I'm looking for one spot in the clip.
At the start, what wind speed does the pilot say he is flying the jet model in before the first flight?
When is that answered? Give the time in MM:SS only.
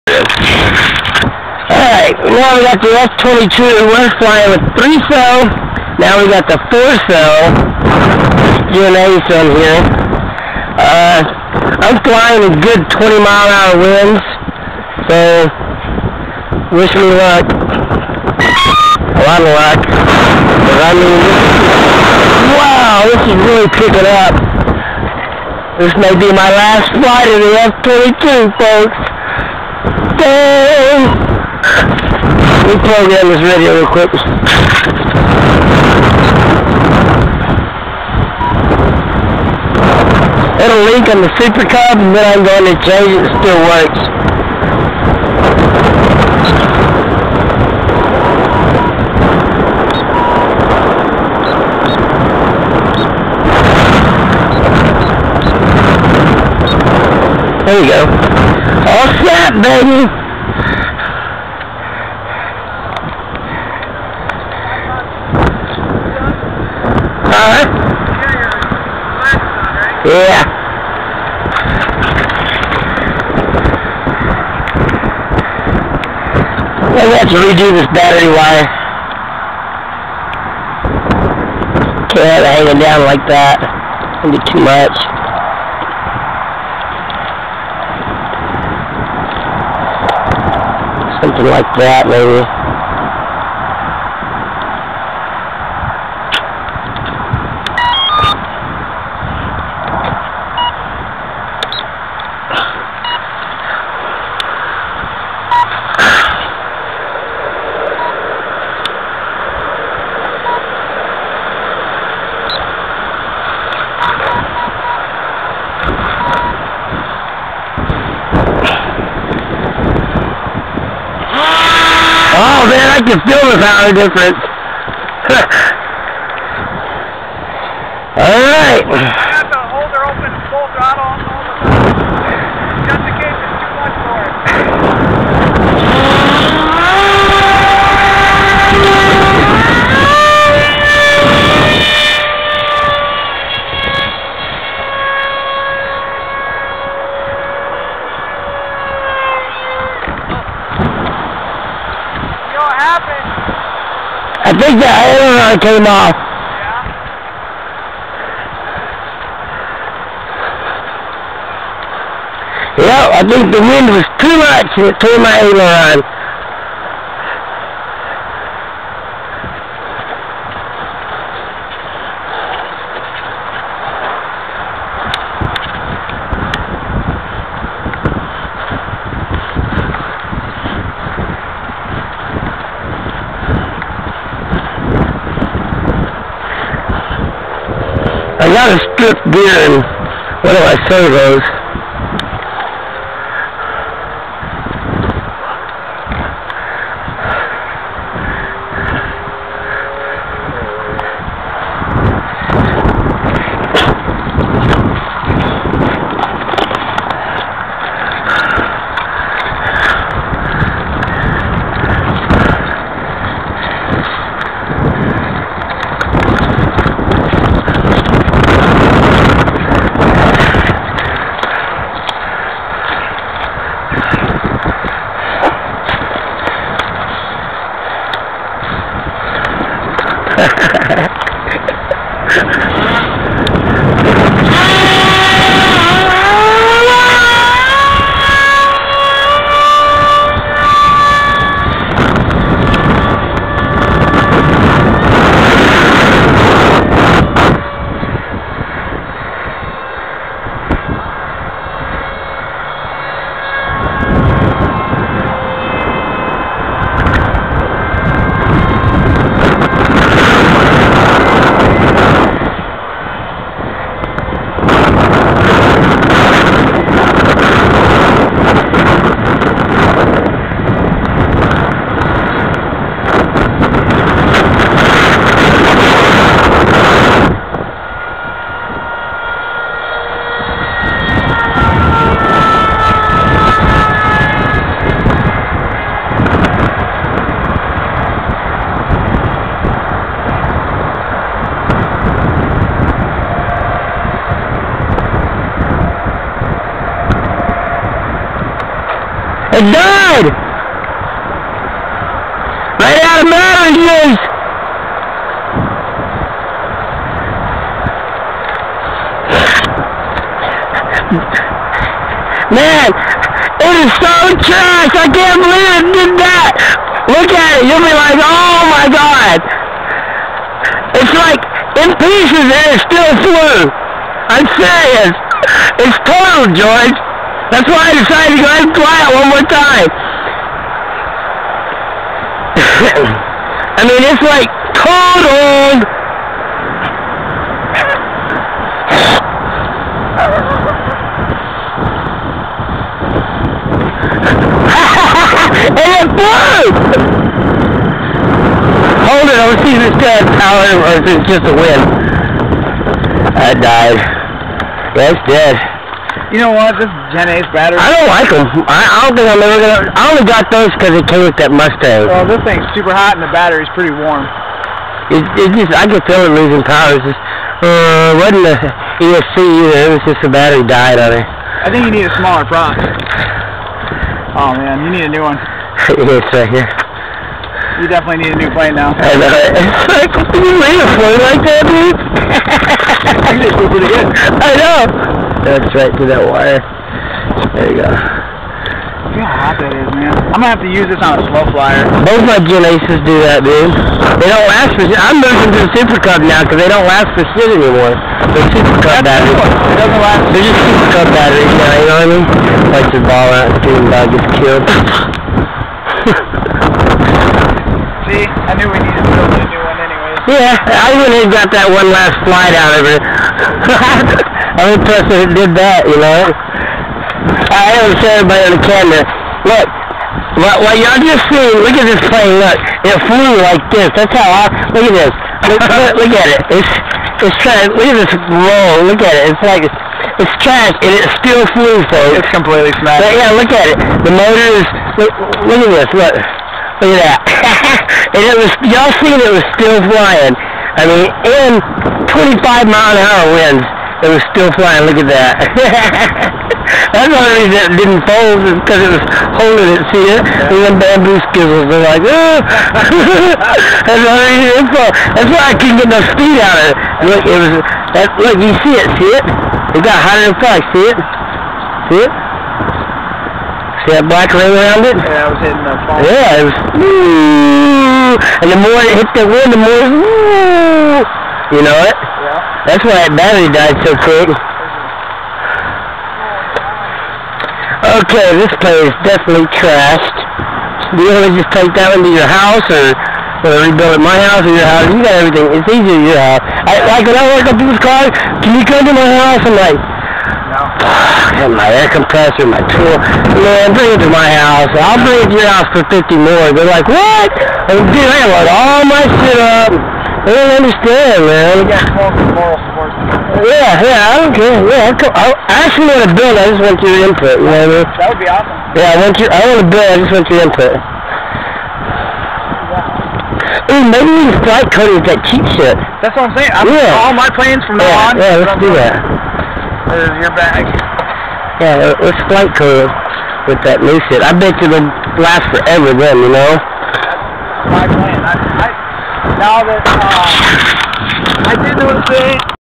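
00:12.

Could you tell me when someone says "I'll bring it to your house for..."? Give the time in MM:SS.
08:14.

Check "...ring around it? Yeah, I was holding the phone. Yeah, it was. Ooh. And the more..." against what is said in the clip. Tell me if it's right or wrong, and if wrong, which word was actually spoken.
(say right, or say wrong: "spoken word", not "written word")
wrong: "hitting", not "holding".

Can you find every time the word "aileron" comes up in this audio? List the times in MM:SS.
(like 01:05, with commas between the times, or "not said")
02:34, 02:45.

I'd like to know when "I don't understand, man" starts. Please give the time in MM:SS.
08:20.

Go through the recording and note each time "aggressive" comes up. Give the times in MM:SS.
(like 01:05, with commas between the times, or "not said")
not said.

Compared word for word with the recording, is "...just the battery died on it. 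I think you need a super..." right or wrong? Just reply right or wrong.
wrong.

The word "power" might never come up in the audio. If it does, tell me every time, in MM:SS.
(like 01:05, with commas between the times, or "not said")
02:03, 05:50, 06:06.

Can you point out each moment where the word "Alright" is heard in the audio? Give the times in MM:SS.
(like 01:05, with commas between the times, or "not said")
00:02, 02:09.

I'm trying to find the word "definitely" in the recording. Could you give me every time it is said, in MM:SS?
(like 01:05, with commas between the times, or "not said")
06:17, 07:59.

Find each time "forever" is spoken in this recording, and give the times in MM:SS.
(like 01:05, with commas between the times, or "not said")
08:45.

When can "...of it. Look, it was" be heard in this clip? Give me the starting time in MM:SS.
07:36.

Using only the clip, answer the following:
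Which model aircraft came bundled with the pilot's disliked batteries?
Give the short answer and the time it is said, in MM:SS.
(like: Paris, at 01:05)
Mustang, at 06:01.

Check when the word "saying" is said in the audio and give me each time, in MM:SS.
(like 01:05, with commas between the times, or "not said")
06:57, 08:36.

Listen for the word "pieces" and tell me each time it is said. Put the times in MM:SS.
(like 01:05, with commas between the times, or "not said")
05:21.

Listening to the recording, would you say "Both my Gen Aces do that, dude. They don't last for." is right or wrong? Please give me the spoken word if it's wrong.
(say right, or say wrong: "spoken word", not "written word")
right.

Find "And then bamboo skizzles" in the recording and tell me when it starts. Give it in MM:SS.
07:30.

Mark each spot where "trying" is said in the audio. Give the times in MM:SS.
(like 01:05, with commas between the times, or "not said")
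07:07.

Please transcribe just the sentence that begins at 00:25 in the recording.
This may be my last flight of the F-22, folks.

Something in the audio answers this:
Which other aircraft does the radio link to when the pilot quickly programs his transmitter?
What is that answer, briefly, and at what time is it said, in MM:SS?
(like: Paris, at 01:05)
Supercub, at 00:41.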